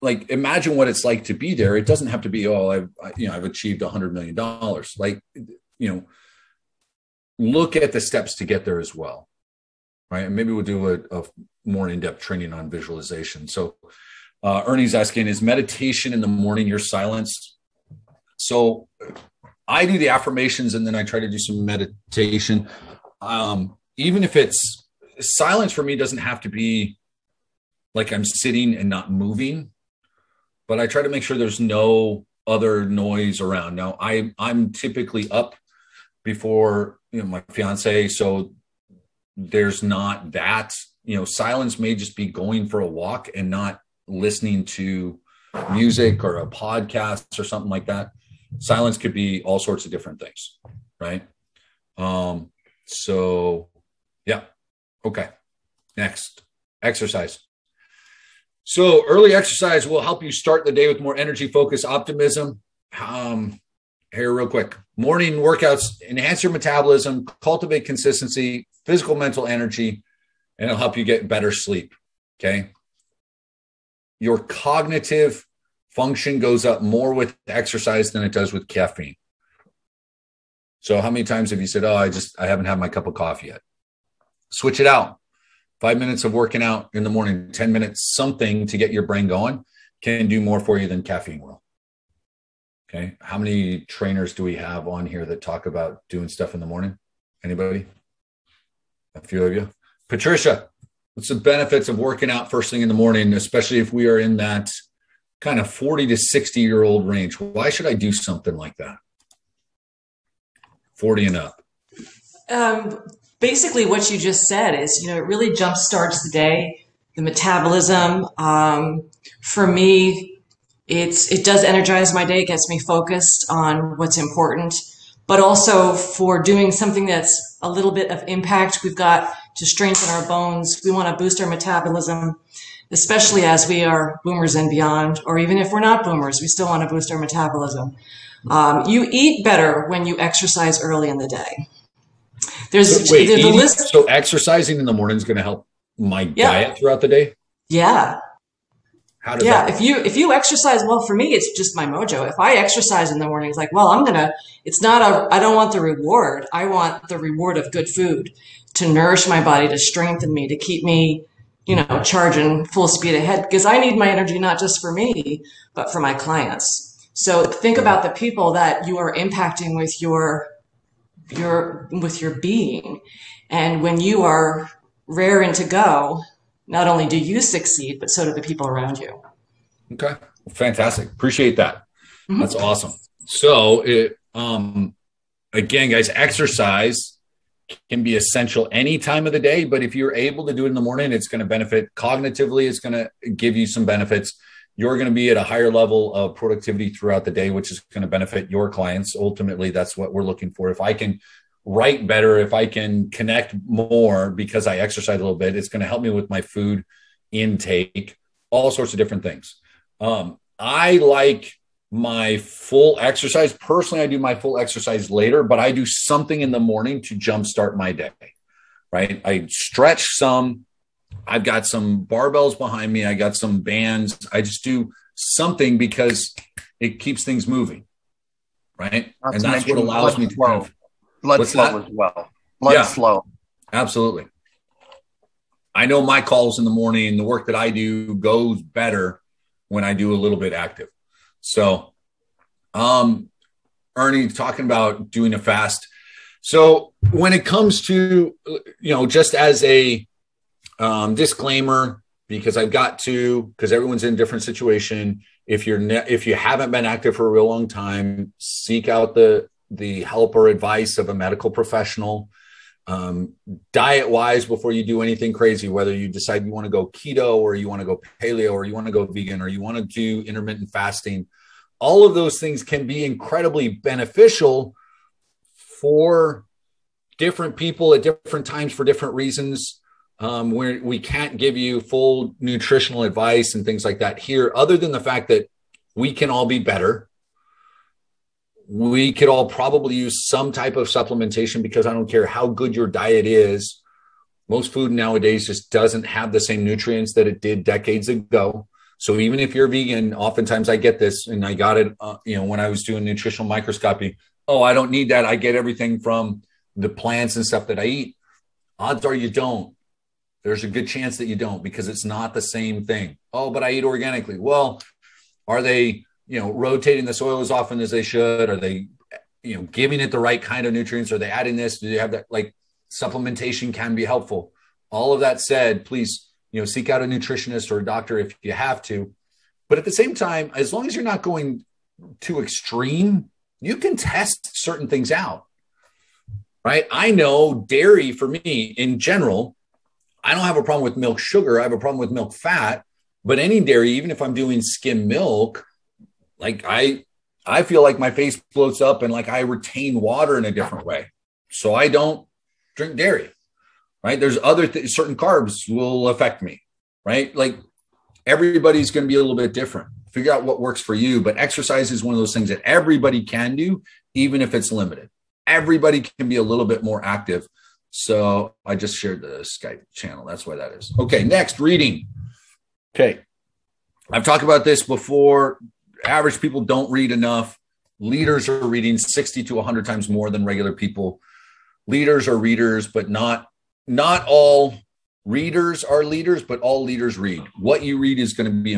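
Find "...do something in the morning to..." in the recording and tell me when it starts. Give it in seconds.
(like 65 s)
215 s.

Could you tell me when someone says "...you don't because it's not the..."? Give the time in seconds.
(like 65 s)
311 s.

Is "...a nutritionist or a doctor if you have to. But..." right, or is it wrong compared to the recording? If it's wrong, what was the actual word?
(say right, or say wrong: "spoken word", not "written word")
right.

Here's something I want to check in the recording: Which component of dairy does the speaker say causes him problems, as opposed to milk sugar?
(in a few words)
milk fat.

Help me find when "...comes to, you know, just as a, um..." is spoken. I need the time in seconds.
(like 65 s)
247 s.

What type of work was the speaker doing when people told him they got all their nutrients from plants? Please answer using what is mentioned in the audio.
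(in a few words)
nutritional microscopy.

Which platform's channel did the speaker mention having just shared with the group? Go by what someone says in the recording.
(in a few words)
Skype.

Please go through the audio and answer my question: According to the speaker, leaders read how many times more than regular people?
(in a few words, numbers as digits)
60 to 100 times.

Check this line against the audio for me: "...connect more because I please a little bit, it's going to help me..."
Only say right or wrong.
wrong.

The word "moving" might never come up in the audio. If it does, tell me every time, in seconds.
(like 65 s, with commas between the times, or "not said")
29 s, 227 s.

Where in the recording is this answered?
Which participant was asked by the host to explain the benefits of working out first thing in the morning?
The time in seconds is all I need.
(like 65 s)
100 s.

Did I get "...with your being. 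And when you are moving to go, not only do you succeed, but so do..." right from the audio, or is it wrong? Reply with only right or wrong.
wrong.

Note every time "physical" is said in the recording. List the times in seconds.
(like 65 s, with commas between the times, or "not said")
68 s.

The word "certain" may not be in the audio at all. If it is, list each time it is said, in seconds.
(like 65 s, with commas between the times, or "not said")
334 s, 354 s.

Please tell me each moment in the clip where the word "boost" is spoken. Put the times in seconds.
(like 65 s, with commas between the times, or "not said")
131 s, 136 s.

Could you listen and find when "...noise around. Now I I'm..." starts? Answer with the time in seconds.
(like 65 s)
32 s.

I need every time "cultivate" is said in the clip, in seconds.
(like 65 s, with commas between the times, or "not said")
67 s.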